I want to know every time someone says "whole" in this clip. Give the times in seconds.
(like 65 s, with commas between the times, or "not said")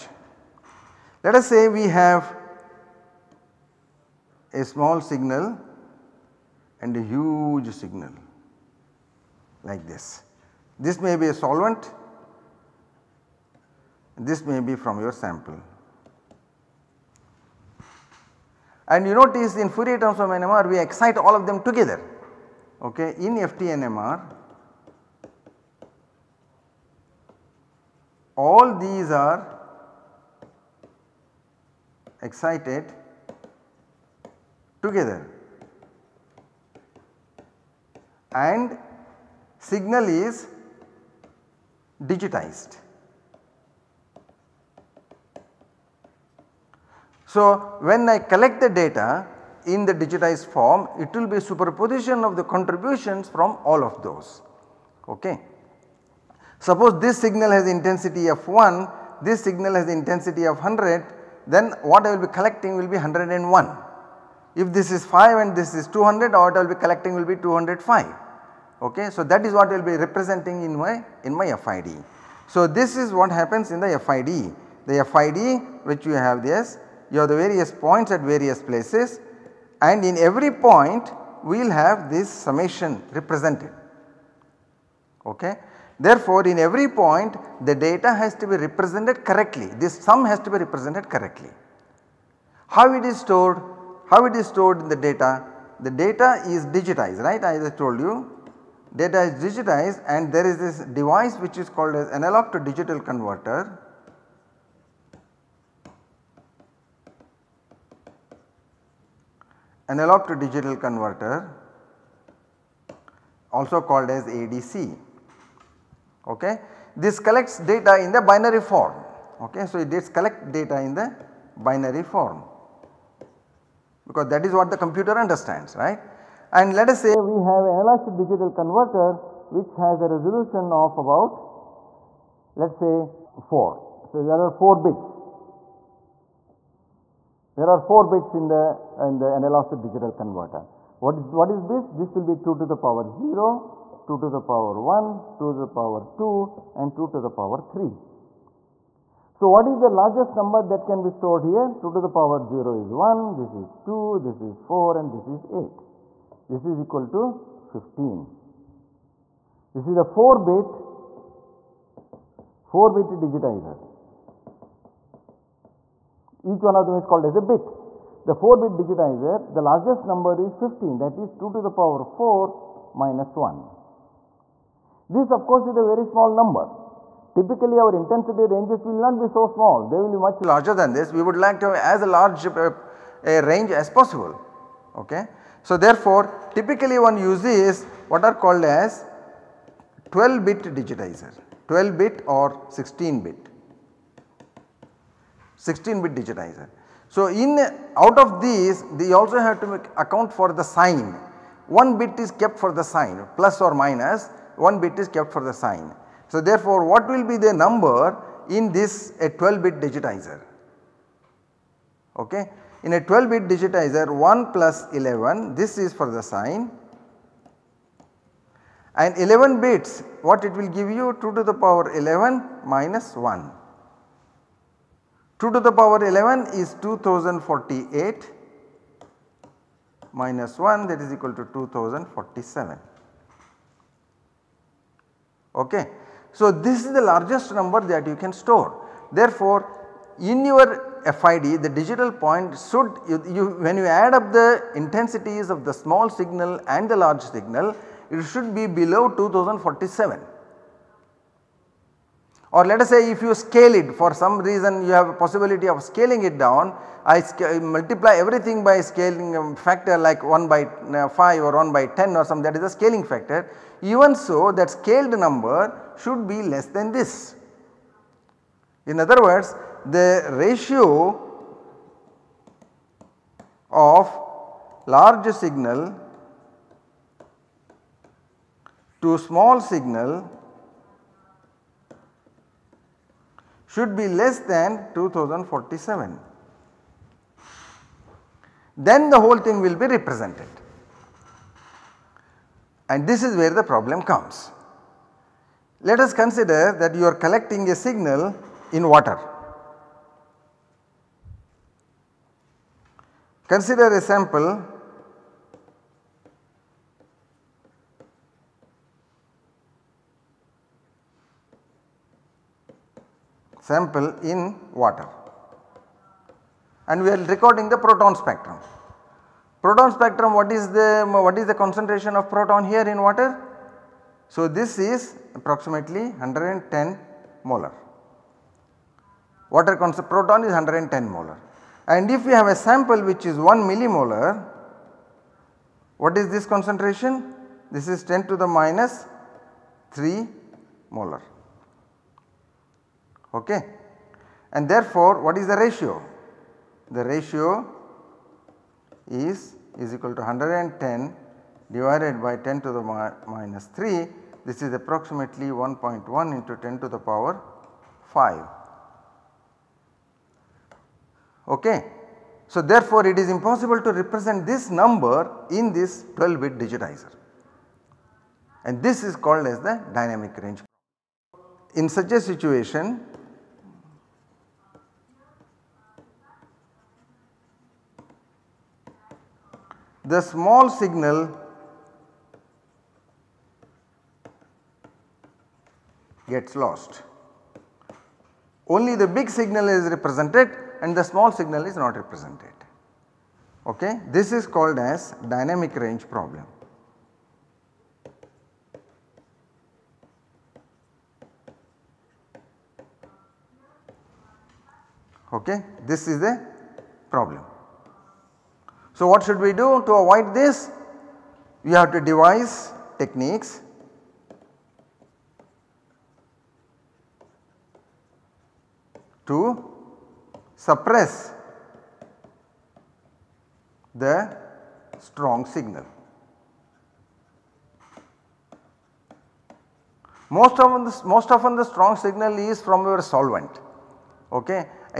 289 s.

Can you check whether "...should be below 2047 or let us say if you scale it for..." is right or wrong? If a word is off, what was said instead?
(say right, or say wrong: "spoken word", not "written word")
right.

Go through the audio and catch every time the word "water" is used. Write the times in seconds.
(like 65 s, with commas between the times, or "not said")
298 s, 314 s, 323 s, 329 s.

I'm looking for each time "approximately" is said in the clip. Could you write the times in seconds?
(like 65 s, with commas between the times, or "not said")
325 s, 354 s.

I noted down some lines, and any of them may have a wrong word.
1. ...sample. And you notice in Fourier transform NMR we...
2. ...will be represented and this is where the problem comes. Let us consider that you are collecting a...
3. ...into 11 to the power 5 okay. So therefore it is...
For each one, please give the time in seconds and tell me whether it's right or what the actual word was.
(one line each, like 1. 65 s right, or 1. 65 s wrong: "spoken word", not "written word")
1. 15 s right
2. 289 s right
3. 356 s wrong: "10", not "11".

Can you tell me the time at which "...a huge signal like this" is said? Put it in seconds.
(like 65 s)
6 s.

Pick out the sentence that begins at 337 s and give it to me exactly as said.
This is 10 to the minus 3 molar okay.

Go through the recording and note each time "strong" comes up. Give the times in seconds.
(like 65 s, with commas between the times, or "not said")
424 s, 431 s.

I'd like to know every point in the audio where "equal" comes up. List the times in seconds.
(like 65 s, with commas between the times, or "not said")
156 s, 231 s, 349 s.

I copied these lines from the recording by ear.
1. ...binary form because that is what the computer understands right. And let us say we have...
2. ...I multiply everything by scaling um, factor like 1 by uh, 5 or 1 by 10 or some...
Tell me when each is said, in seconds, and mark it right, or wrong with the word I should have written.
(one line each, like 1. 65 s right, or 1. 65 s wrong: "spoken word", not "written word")
1. 121 s right
2. 257 s right.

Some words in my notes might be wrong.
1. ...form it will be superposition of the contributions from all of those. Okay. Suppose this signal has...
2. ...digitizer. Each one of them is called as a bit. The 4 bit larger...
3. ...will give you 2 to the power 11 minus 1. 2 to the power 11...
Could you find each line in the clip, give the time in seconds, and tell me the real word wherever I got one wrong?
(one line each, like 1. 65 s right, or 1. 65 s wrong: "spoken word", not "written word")
1. 50 s right
2. 163 s wrong: "digitizer", not "larger"
3. 220 s right.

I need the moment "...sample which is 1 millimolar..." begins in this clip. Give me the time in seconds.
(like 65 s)
332 s.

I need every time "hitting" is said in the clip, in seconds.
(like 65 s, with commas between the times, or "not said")
not said.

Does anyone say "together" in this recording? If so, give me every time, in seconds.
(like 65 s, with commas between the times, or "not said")
21 s, 34 s.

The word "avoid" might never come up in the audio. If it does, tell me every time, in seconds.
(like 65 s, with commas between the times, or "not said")
409 s.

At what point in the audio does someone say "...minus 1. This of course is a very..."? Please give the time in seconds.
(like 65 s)
172 s.